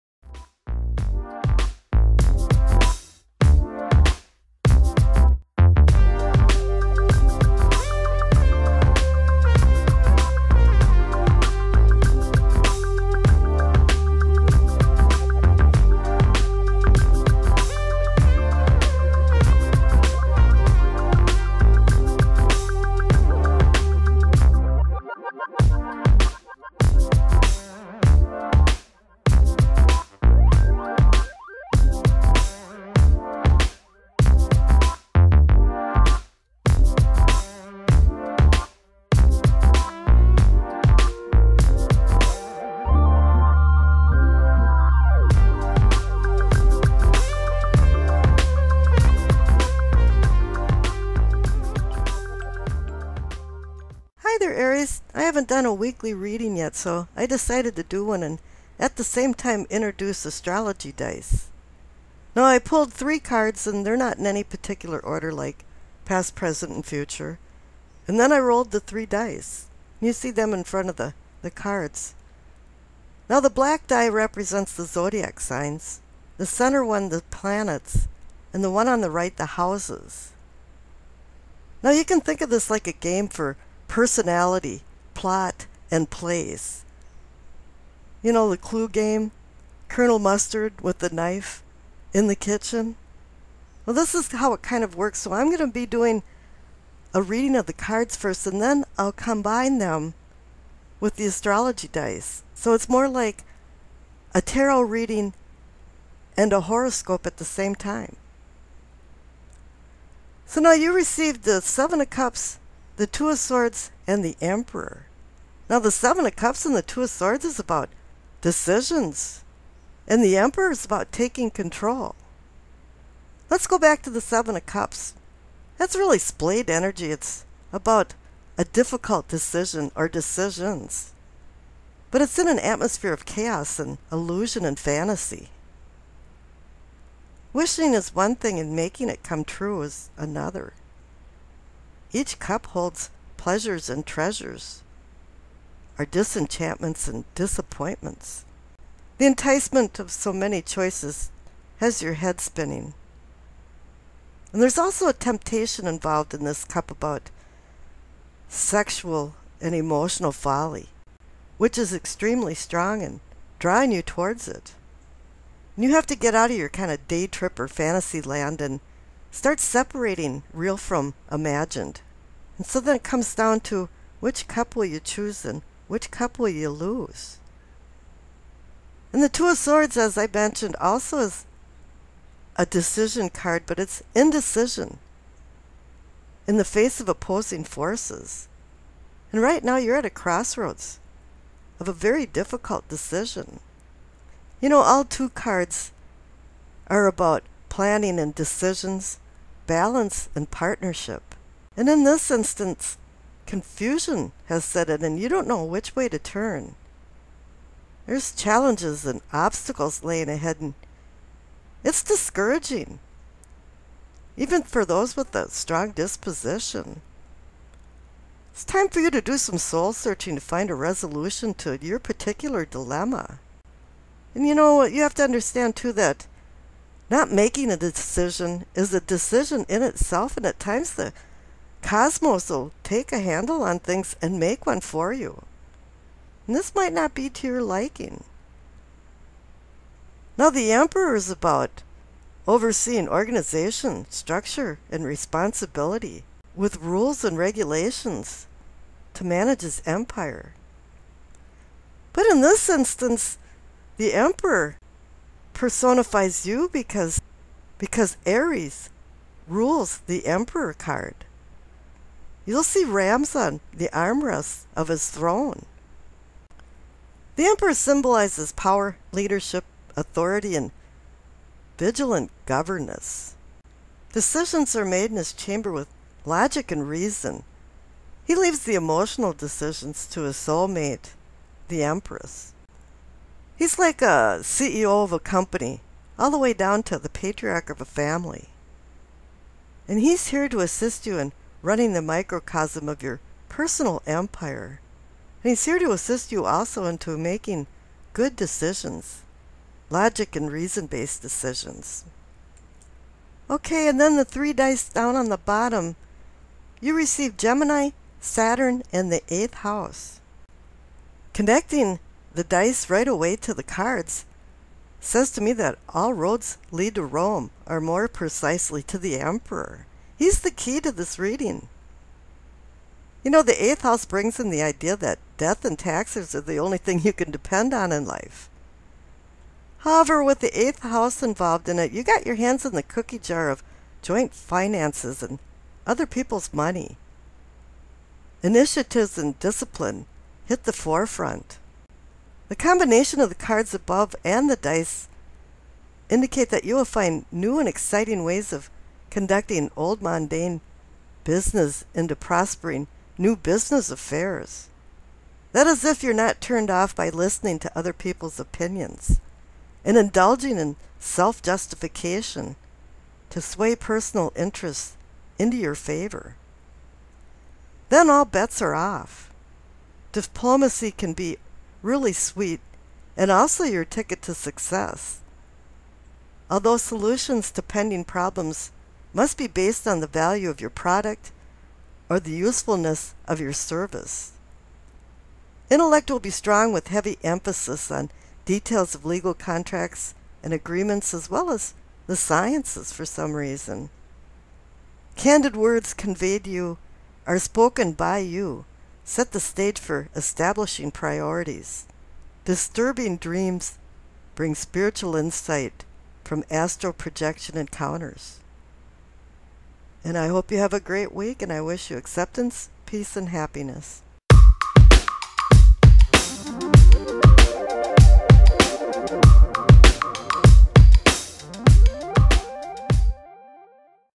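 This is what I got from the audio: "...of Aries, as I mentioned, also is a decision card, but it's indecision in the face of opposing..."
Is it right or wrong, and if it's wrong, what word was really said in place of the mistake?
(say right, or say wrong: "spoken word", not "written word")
wrong: "Swords", not "Aries".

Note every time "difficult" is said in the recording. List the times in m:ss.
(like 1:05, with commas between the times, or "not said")
2:08, 3:12.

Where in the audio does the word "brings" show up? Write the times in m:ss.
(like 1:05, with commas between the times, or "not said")
5:24, 6:44.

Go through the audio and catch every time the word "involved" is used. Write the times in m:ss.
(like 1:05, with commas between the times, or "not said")
2:35, 5:31.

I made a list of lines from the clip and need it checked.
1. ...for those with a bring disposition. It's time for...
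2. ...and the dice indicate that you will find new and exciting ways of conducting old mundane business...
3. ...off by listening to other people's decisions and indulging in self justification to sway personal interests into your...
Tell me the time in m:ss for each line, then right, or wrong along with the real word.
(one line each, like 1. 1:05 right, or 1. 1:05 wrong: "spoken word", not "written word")
1. 3:34 wrong: "strong", not "bring"
2. 5:44 right
3. 5:56 wrong: "opinions", not "decisions".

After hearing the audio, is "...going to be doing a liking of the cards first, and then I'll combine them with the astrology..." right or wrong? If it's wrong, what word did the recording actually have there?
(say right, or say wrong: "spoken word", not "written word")
wrong: "reading", not "liking".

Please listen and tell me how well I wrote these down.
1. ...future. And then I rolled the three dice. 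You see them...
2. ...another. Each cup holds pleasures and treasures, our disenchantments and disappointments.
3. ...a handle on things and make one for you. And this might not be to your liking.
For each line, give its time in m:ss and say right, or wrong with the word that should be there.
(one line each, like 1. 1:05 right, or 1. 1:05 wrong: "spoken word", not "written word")
1. 1:06 right
2. 2:20 right
3. 3:53 right.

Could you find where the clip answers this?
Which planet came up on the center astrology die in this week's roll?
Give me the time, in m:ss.
5:08.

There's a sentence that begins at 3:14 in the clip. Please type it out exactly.
You know, all two cards are about planning and decisions, balance and partnership.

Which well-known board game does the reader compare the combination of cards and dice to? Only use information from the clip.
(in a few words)
Clue.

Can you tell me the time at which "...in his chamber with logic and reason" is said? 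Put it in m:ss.
4:35.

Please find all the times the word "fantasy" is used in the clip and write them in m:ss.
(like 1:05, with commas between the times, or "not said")
2:14, 2:47.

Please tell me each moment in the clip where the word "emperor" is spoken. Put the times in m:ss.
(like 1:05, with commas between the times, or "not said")
1:54, 2:00, 4:00, 4:14, 4:20, 4:27, 5:19.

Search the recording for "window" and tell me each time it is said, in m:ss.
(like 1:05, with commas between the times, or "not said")
not said.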